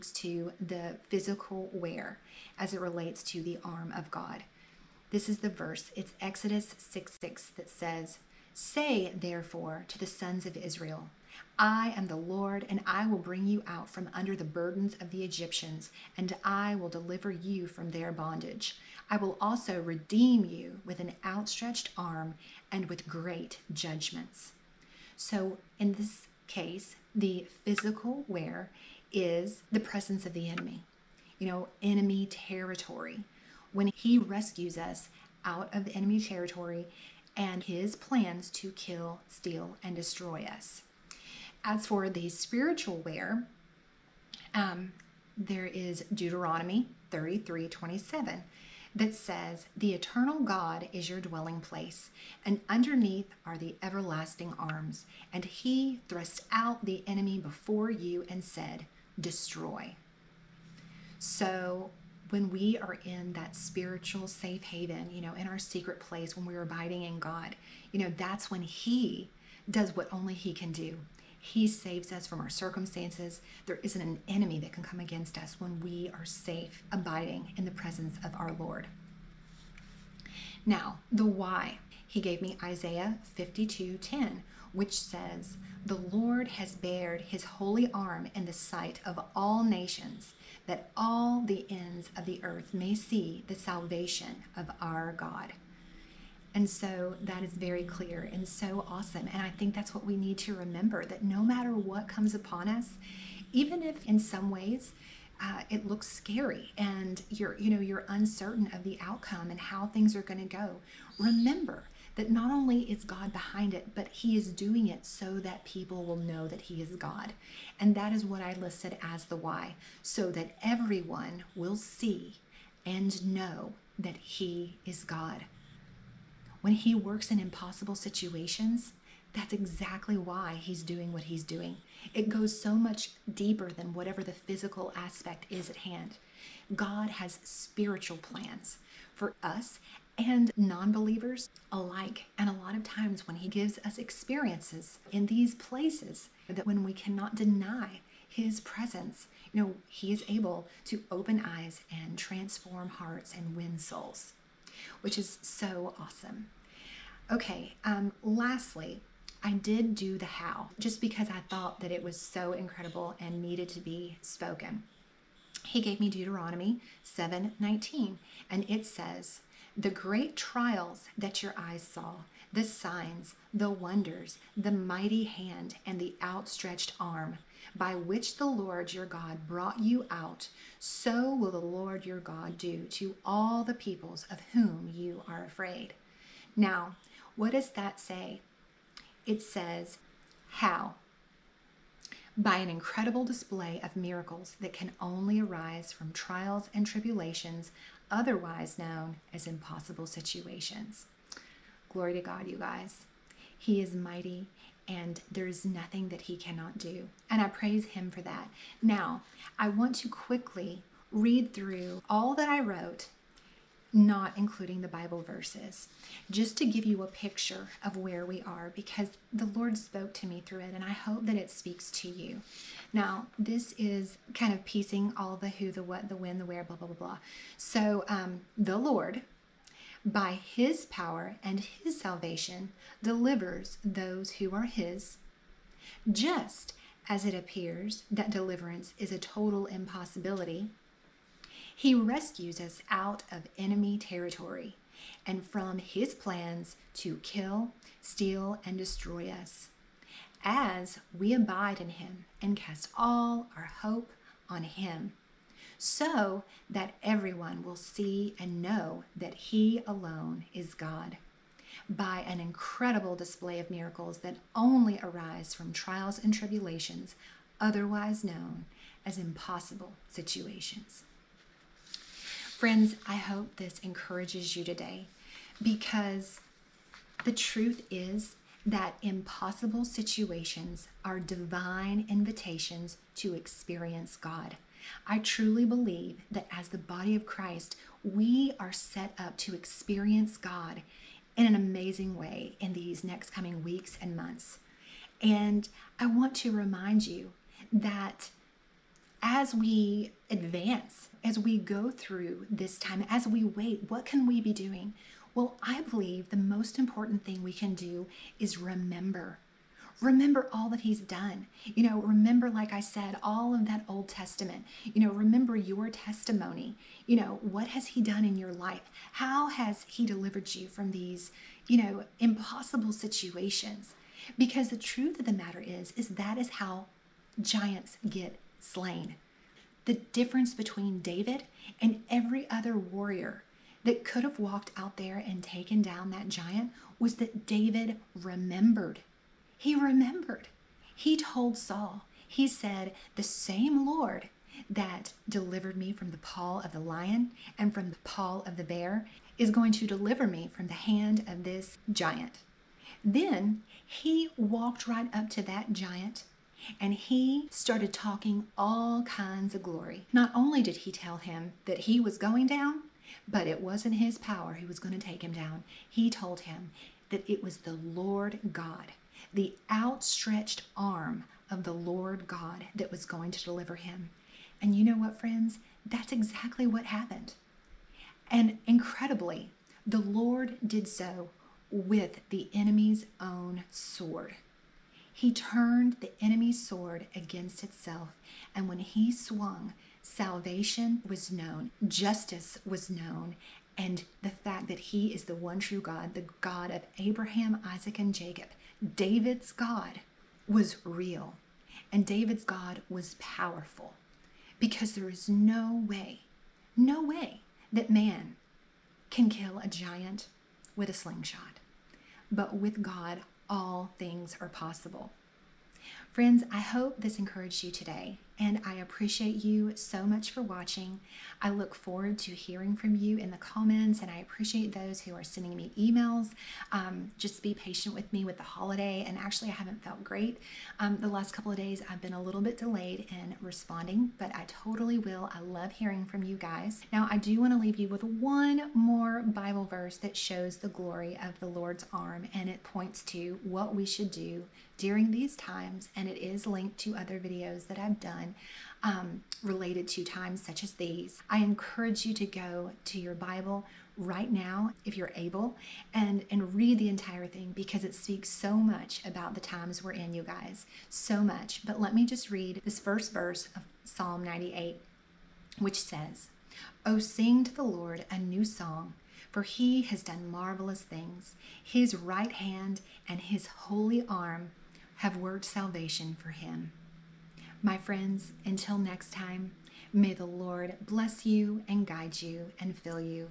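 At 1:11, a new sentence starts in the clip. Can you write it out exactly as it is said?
He saves us from our circumstances.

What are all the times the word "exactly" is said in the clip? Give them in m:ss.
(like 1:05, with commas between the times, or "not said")
2:09, 6:16.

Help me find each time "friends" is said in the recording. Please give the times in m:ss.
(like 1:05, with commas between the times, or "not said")
4:32, 6:15, 6:56, 7:57.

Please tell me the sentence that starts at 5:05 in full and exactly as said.
Well, I believe the most important thing we can do is remember Remember all that he's done.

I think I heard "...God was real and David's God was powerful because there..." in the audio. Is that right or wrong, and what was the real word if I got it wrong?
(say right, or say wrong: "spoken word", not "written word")
right.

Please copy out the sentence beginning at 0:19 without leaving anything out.
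I will also redeem you with an outstretched arm and with great judgments.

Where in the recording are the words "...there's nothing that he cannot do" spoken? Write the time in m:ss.
3:25.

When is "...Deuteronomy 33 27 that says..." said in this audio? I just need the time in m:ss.
0:46.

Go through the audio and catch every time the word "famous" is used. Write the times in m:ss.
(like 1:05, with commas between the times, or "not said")
not said.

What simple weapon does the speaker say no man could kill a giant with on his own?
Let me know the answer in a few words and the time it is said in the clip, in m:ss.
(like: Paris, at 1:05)
A slingshot, at 6:50.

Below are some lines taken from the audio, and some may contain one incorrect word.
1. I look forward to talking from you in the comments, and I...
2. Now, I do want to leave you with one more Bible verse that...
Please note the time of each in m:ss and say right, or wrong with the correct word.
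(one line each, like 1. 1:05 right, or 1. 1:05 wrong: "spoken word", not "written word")
1. 7:01 wrong: "hearing", not "talking"
2. 7:16 right.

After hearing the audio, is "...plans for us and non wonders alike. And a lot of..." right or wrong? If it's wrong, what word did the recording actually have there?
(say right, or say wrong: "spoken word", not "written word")
wrong: "believers", not "wonders".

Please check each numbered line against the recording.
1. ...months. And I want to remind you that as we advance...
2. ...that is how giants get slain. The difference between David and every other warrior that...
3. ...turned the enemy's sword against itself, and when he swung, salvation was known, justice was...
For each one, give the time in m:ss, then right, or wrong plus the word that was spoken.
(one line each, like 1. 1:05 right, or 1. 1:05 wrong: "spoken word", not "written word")
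1. 4:54 right
2. 5:26 right
3. 6:25 right.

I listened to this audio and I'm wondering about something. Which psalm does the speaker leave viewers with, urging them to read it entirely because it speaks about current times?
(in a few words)
Psalm 98.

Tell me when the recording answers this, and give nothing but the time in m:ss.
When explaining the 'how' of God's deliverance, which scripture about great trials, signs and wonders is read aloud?
2:46.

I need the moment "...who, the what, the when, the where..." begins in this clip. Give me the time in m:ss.
3:45.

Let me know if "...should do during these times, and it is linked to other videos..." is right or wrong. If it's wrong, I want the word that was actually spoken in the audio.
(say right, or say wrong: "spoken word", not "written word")
right.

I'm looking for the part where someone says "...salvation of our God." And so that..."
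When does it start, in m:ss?
1:33.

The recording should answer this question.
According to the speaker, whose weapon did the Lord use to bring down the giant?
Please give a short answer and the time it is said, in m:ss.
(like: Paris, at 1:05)
The enemy's own sword, at 6:22.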